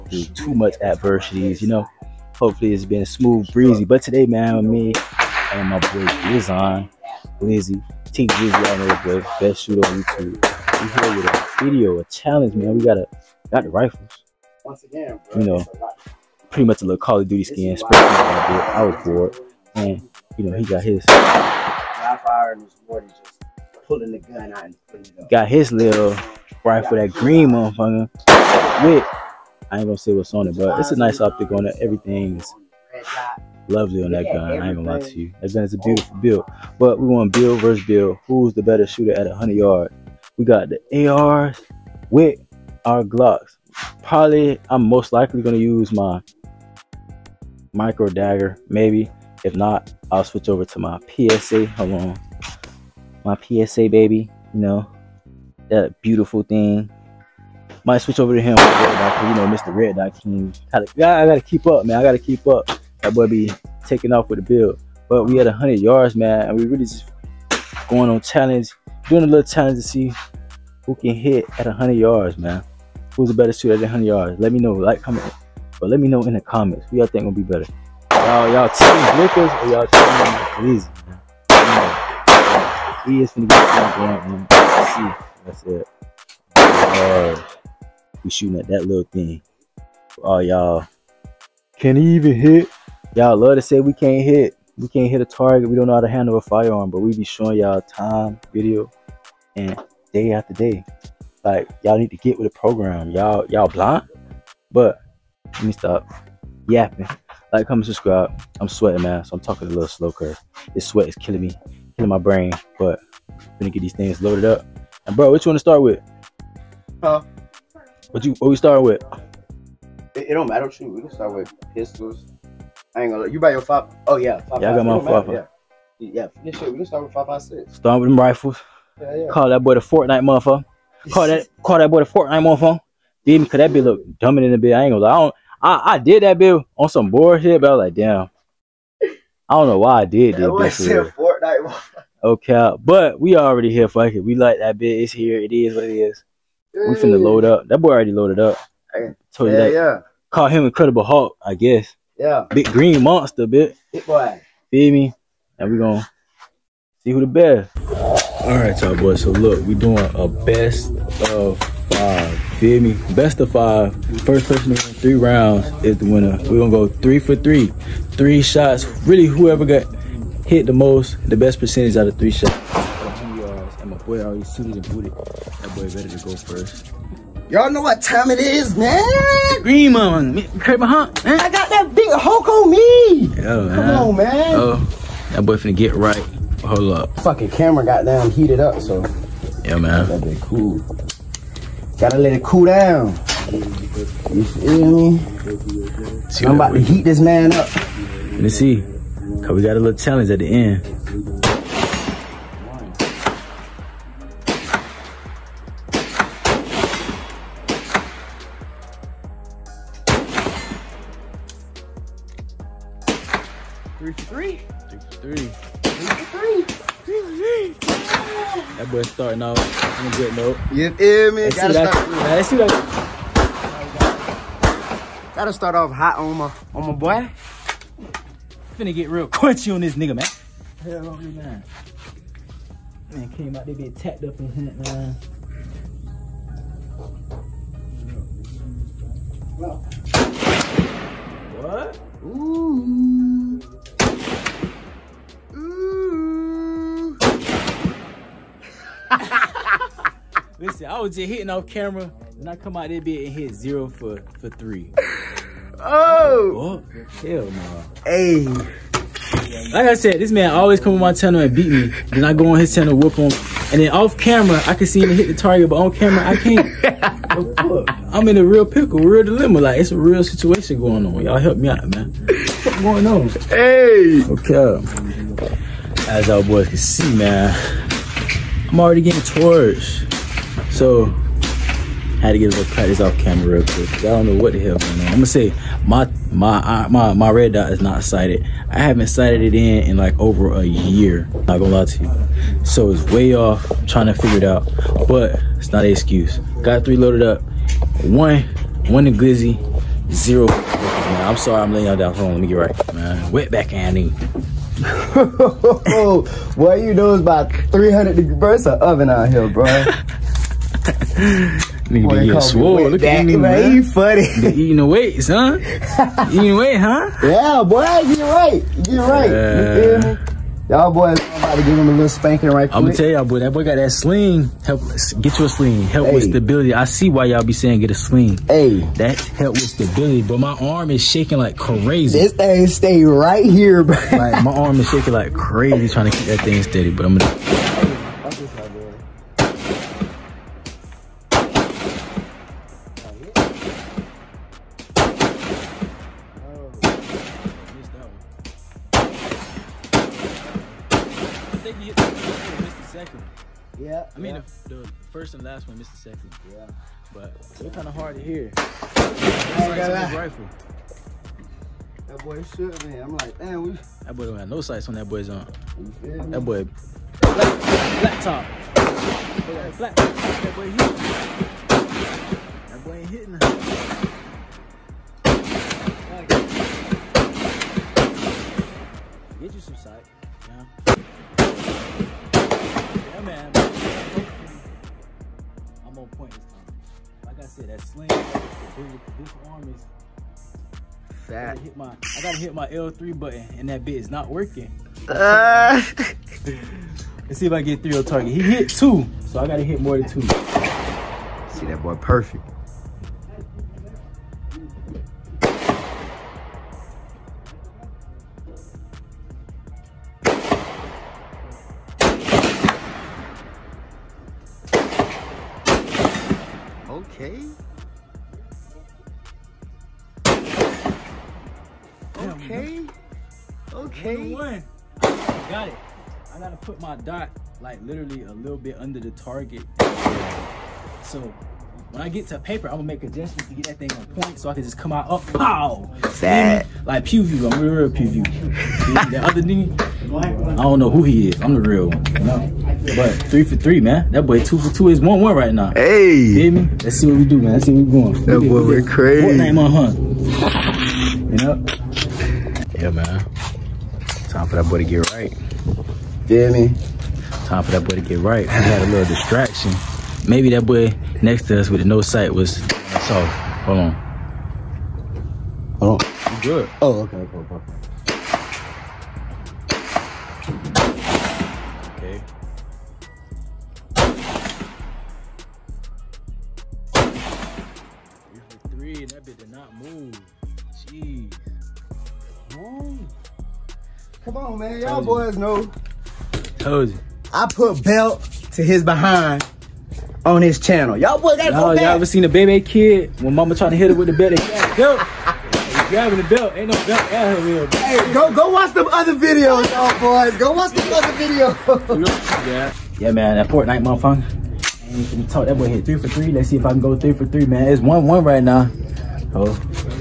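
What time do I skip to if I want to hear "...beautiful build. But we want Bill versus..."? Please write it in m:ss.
0:35.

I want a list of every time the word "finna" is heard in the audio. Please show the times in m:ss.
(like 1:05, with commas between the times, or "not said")
2:26, 3:05, 3:48.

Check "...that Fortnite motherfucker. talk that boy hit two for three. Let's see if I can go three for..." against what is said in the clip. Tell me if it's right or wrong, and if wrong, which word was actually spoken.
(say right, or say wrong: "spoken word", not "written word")
wrong: "three", not "two".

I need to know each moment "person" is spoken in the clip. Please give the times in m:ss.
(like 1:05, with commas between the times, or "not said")
2:44.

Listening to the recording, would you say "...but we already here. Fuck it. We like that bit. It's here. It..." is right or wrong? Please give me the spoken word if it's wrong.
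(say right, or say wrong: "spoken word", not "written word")
right.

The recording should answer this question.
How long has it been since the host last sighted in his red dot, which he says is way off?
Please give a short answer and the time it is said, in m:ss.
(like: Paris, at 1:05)
Over a year, at 4:50.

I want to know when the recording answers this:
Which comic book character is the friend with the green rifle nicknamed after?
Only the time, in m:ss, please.
2:30.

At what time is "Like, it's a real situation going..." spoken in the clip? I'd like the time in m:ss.
4:29.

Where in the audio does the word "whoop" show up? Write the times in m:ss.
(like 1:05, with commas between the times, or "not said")
4:22.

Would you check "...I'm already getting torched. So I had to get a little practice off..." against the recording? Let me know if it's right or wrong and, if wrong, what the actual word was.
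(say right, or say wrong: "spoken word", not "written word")
right.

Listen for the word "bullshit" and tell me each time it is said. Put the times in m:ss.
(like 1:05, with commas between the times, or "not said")
2:17.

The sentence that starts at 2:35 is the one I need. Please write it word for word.
And we gonna see who the best.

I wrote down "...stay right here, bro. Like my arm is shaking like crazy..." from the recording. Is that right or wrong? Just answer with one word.
right.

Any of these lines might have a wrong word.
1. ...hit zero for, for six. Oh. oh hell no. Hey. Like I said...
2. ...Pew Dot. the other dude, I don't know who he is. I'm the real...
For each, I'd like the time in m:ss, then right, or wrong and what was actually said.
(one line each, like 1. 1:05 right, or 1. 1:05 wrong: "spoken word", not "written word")
1. 4:13 wrong: "three", not "six"
2. 7:17 wrong: "View", not "Dot".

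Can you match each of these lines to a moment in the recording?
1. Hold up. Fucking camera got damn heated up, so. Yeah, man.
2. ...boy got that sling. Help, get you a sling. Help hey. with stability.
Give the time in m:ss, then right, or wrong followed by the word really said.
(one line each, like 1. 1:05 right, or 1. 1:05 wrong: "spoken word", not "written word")
1. 3:06 right
2. 5:23 right.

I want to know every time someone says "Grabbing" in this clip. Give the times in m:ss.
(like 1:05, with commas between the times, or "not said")
8:15.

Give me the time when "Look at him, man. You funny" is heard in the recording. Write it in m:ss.
5:12.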